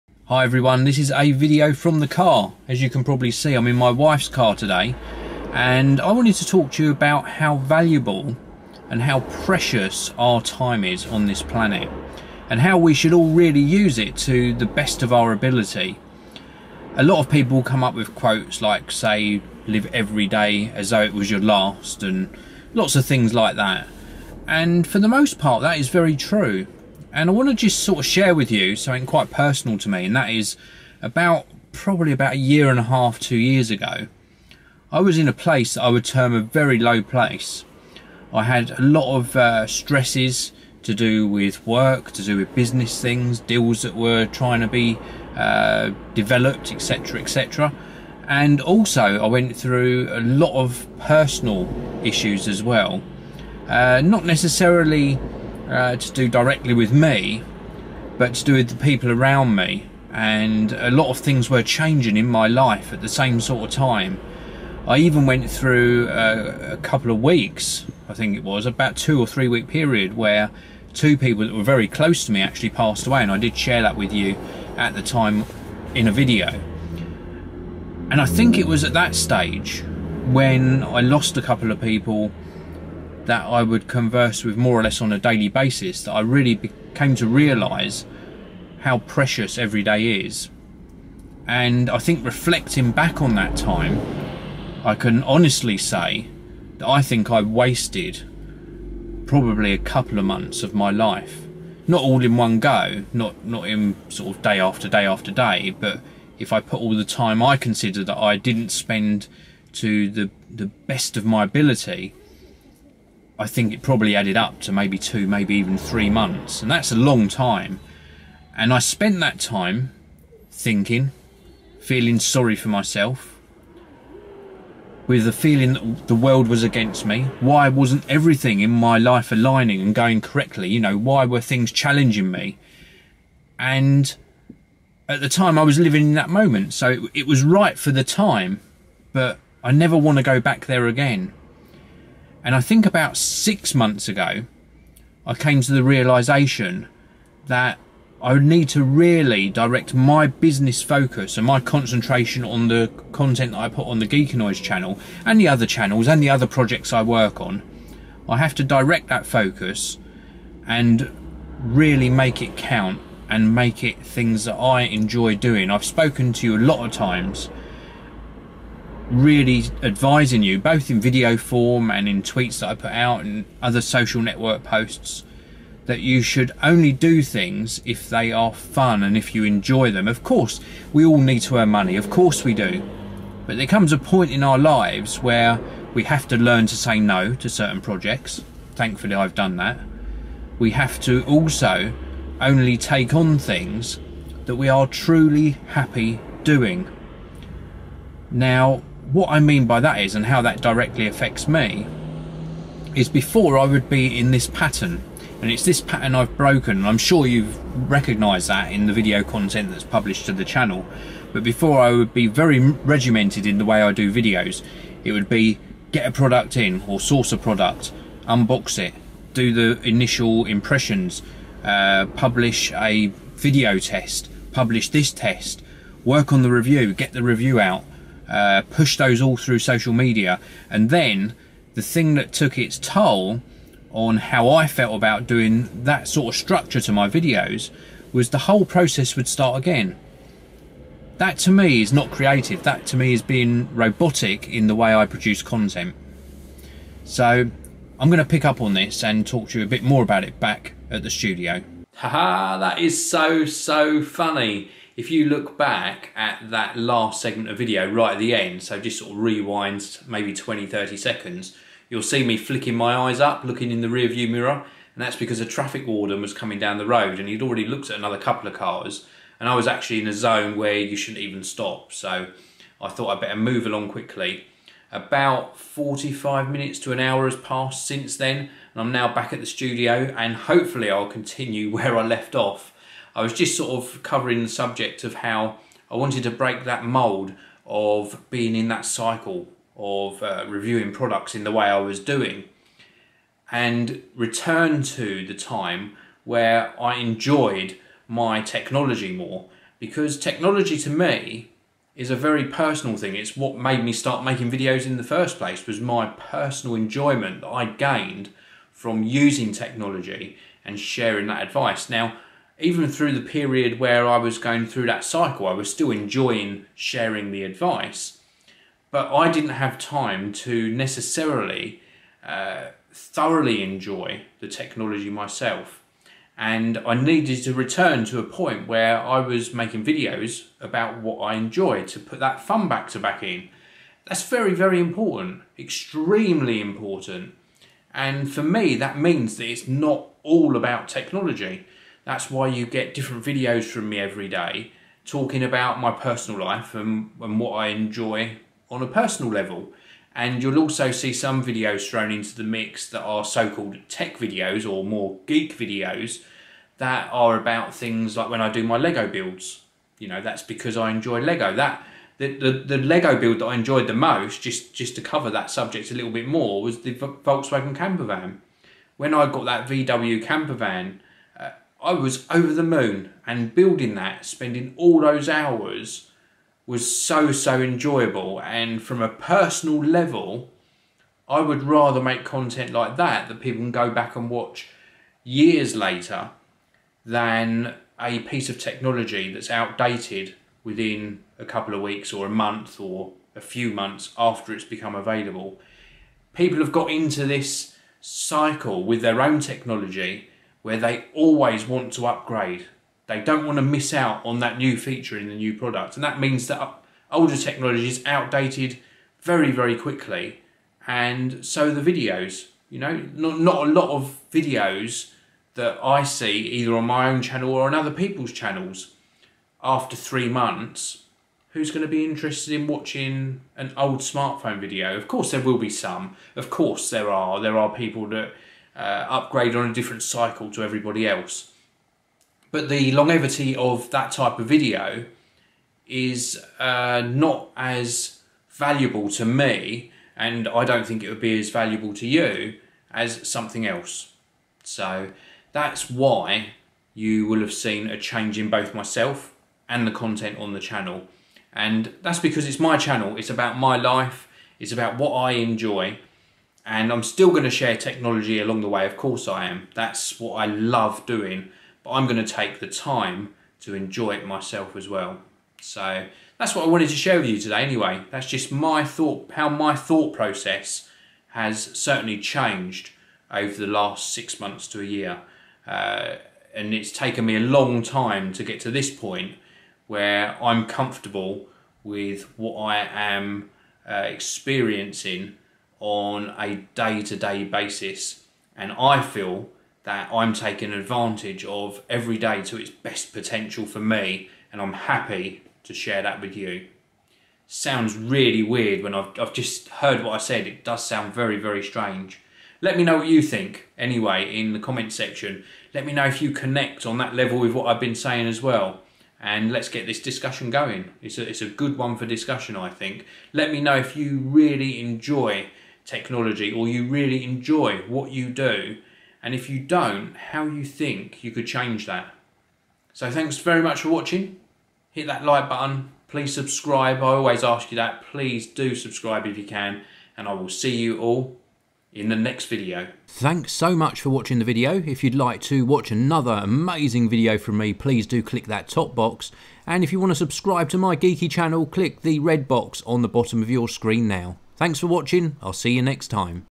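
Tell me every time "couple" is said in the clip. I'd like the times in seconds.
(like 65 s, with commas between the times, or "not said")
66 s, 81 s, 99 s, 268 s, 391 s.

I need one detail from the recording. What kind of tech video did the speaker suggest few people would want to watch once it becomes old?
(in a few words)
Smartphone video.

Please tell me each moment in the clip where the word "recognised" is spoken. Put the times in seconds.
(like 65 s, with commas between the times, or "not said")
207 s.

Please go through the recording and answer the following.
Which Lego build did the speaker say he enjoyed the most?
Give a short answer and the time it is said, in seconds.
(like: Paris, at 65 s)
Volkswagen camper van, at 366 s.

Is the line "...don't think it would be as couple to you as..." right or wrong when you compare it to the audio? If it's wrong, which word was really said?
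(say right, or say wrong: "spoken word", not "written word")
wrong: "valuable", not "couple".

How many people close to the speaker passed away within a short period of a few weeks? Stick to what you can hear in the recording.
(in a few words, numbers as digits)
2.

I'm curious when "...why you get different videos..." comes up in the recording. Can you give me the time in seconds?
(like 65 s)
342 s.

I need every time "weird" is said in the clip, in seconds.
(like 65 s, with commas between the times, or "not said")
498 s.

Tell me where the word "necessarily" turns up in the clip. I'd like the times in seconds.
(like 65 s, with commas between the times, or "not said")
54 s, 320 s.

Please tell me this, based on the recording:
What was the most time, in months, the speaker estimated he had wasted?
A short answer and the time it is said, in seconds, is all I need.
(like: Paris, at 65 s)
3 months, at 115 s.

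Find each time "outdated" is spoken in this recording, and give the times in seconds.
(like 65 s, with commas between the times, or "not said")
389 s, 408 s.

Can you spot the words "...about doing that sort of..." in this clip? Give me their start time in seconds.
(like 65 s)
234 s.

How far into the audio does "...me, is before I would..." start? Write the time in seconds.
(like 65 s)
201 s.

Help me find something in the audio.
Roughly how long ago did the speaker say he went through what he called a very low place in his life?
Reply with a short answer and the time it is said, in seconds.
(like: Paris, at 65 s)
A year and a half, two years, at 32 s.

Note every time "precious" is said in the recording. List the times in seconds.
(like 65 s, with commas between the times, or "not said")
9 s, 88 s.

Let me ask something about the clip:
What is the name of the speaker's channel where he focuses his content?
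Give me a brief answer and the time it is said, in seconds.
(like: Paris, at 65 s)
Geekanoids, at 154 s.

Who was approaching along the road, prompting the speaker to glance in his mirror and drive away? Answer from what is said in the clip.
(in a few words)
A traffic warden.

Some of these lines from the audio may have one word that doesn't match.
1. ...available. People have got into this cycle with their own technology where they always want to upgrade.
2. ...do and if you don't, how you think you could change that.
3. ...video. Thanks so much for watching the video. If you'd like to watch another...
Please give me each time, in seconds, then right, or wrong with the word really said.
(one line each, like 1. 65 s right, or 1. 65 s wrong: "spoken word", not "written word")
1. 394 s right
2. 518 s right
3. 532 s right.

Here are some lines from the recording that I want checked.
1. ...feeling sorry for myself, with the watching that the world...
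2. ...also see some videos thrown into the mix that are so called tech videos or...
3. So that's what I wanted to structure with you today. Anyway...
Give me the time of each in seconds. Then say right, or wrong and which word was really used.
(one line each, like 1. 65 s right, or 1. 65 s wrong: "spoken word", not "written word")
1. 121 s wrong: "feeling", not "watching"
2. 350 s right
3. 465 s wrong: "share", not "structure".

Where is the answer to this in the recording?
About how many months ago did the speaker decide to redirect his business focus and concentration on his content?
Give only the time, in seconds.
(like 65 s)
142 s.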